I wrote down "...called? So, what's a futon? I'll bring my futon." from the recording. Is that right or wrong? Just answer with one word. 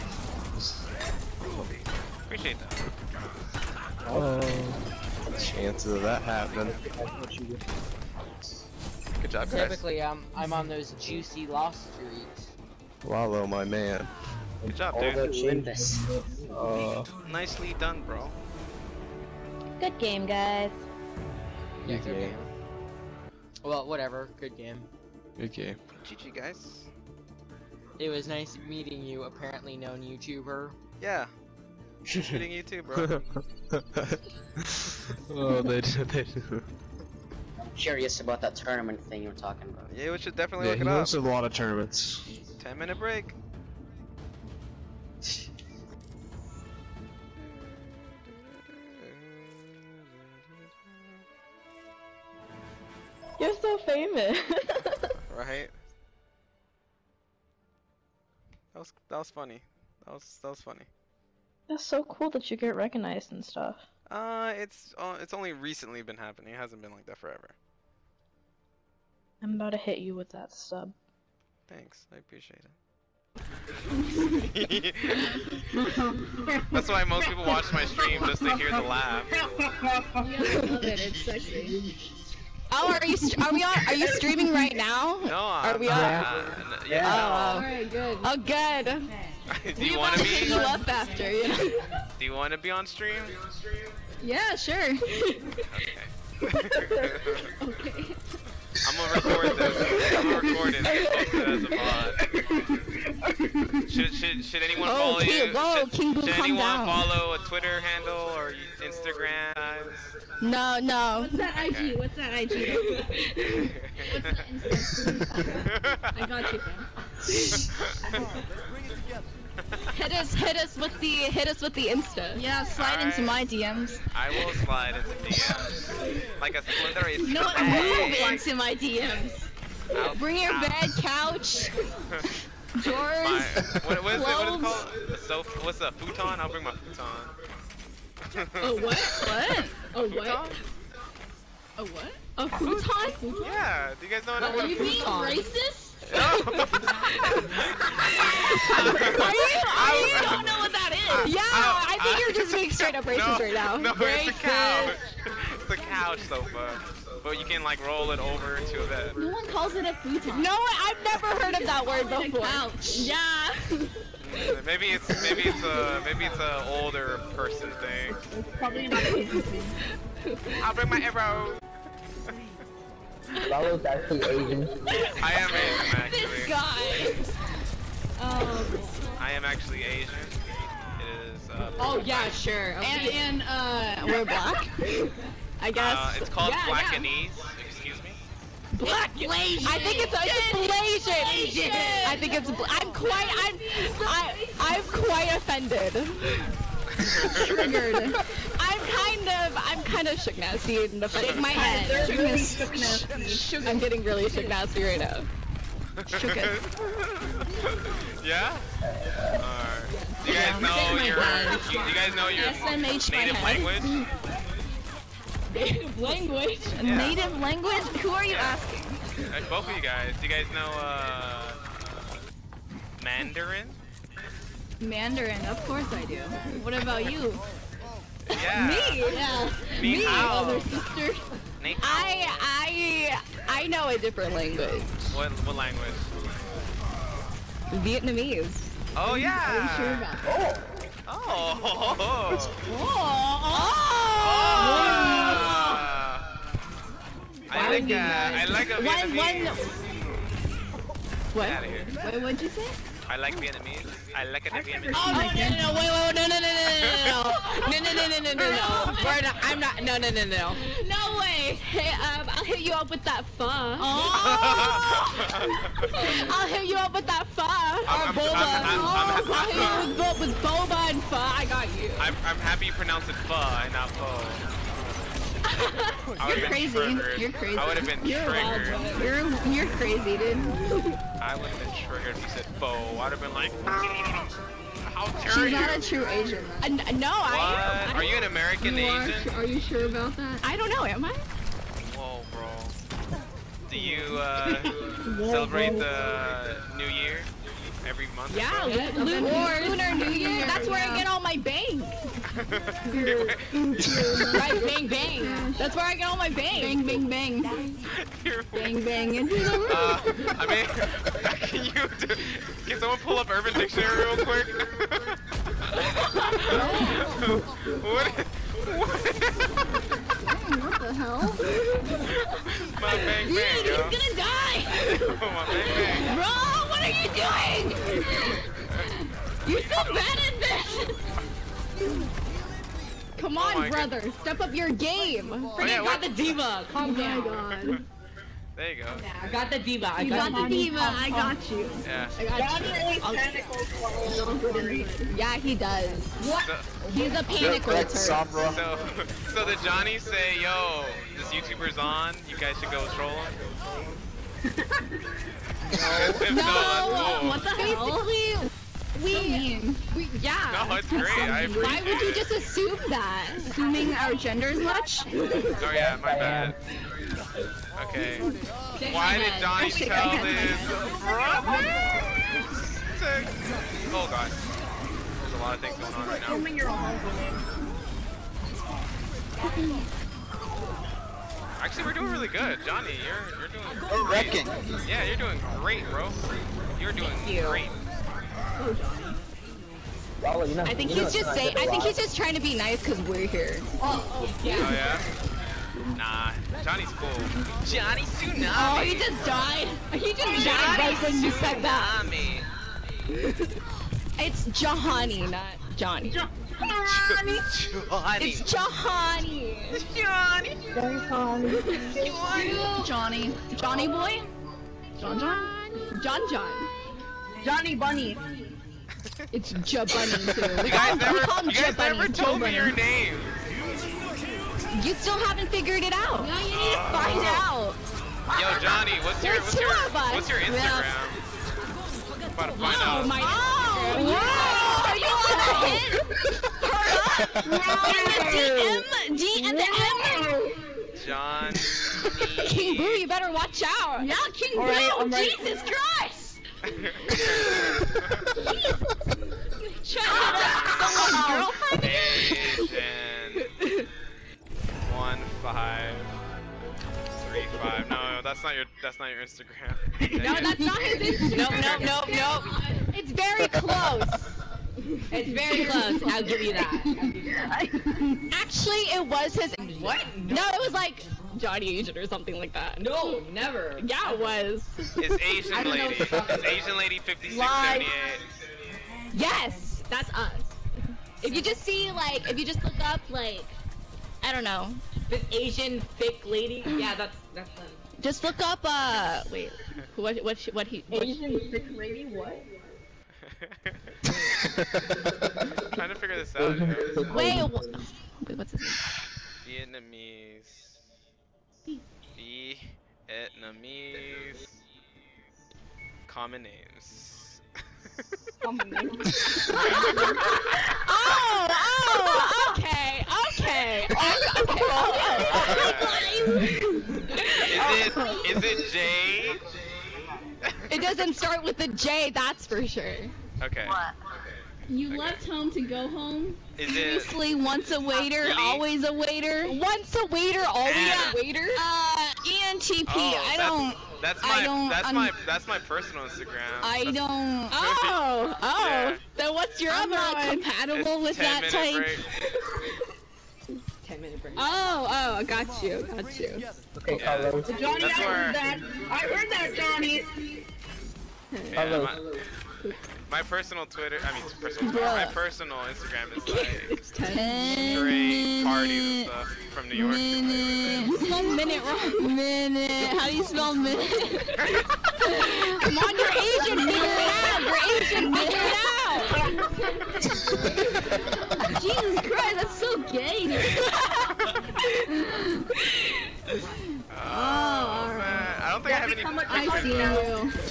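right.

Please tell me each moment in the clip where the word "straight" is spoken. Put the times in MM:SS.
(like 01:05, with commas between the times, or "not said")
02:32, 09:16.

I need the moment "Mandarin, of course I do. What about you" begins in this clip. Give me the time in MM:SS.
03:44.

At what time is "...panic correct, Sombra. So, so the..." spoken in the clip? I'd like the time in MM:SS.
05:47.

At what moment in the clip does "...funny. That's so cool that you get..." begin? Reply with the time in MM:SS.
01:00.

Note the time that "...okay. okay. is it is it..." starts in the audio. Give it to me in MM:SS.
08:34.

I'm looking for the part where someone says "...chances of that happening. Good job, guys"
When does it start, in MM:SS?
00:05.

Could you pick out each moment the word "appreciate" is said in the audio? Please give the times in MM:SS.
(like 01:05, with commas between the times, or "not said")
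00:02, 01:12.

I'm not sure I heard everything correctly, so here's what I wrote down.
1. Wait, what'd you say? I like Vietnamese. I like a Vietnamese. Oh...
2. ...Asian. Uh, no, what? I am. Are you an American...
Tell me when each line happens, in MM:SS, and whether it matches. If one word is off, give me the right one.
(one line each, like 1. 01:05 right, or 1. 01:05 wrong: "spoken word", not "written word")
1. 04:11 right
2. 04:46 right.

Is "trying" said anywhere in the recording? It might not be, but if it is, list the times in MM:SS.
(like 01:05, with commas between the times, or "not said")
06:32, 08:15.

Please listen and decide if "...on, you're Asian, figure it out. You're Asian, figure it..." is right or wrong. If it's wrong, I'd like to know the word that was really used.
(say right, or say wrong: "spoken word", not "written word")
right.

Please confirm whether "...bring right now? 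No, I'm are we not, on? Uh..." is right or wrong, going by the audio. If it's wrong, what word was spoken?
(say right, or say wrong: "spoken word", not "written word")
wrong: "streaming", not "bring".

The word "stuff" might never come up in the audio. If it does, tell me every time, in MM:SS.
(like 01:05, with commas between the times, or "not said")
01:03, 09:19.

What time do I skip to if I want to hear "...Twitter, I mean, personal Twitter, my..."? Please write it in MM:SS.
09:13.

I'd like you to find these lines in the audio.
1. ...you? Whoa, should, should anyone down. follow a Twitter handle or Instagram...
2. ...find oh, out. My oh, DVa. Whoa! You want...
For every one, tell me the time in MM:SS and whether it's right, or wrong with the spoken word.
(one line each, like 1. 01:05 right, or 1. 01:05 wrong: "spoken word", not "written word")
1. 01:45 right
2. 07:12 wrong: "Instagram", not "DVa".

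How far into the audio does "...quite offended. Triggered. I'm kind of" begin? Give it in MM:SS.
03:14.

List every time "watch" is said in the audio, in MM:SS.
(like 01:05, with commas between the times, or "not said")
01:17, 07:23.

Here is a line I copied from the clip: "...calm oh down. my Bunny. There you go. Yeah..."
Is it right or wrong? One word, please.
wrong.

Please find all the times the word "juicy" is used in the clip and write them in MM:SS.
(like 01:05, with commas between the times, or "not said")
00:10.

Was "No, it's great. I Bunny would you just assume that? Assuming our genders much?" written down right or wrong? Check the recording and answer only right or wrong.
wrong.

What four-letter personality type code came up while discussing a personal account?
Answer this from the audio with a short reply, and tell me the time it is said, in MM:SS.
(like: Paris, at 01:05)
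ENTP, at 08:52.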